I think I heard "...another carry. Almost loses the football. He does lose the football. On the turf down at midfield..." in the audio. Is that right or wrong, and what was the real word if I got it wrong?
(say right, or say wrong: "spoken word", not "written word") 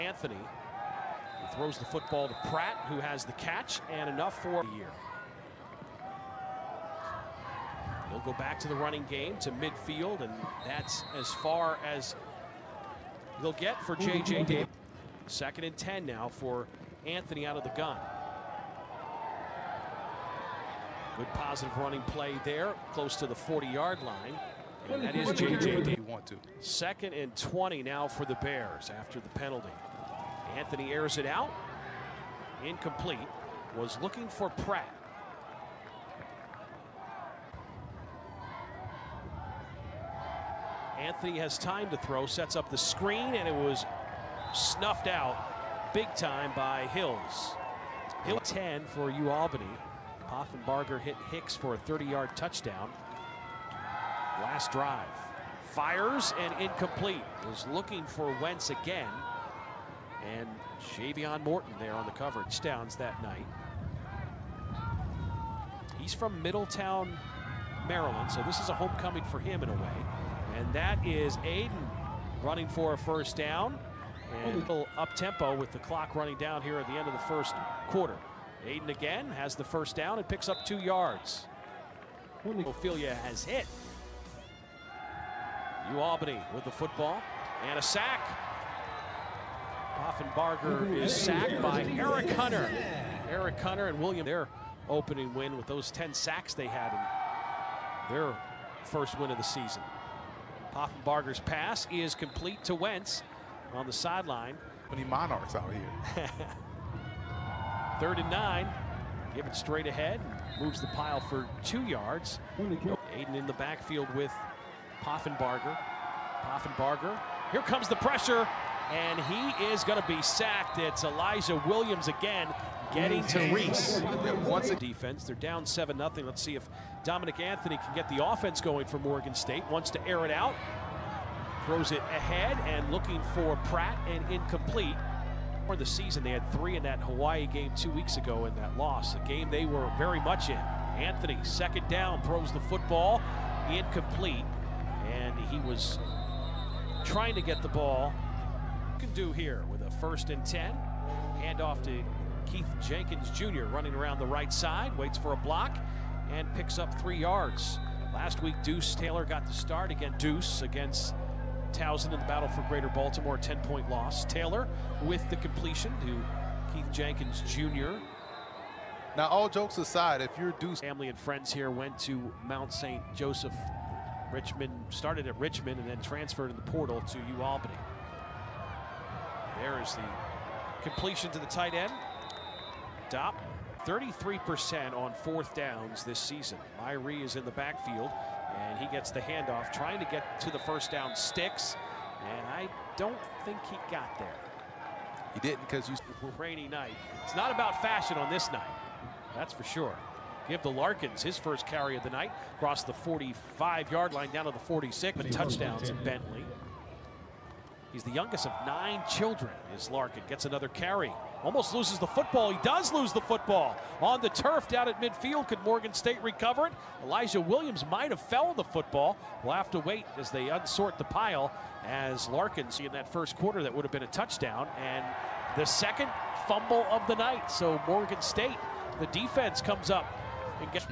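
right.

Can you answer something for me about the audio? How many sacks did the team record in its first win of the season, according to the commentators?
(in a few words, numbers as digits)
10.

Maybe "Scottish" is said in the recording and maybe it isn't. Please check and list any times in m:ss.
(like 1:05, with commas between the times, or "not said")
not said.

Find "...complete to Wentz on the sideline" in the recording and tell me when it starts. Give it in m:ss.
1:42.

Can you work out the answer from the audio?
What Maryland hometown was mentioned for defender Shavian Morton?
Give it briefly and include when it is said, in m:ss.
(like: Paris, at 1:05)
Middletown, Maryland, at 1:06.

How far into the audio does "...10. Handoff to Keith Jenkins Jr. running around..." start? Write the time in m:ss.
2:30.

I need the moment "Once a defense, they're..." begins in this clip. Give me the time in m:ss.
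2:04.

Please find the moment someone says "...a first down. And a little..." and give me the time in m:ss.
1:12.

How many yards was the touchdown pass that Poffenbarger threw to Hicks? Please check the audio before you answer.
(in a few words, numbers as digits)
30.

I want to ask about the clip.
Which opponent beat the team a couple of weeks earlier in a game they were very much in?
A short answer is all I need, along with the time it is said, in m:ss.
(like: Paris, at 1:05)
Hawaii, at 2:17.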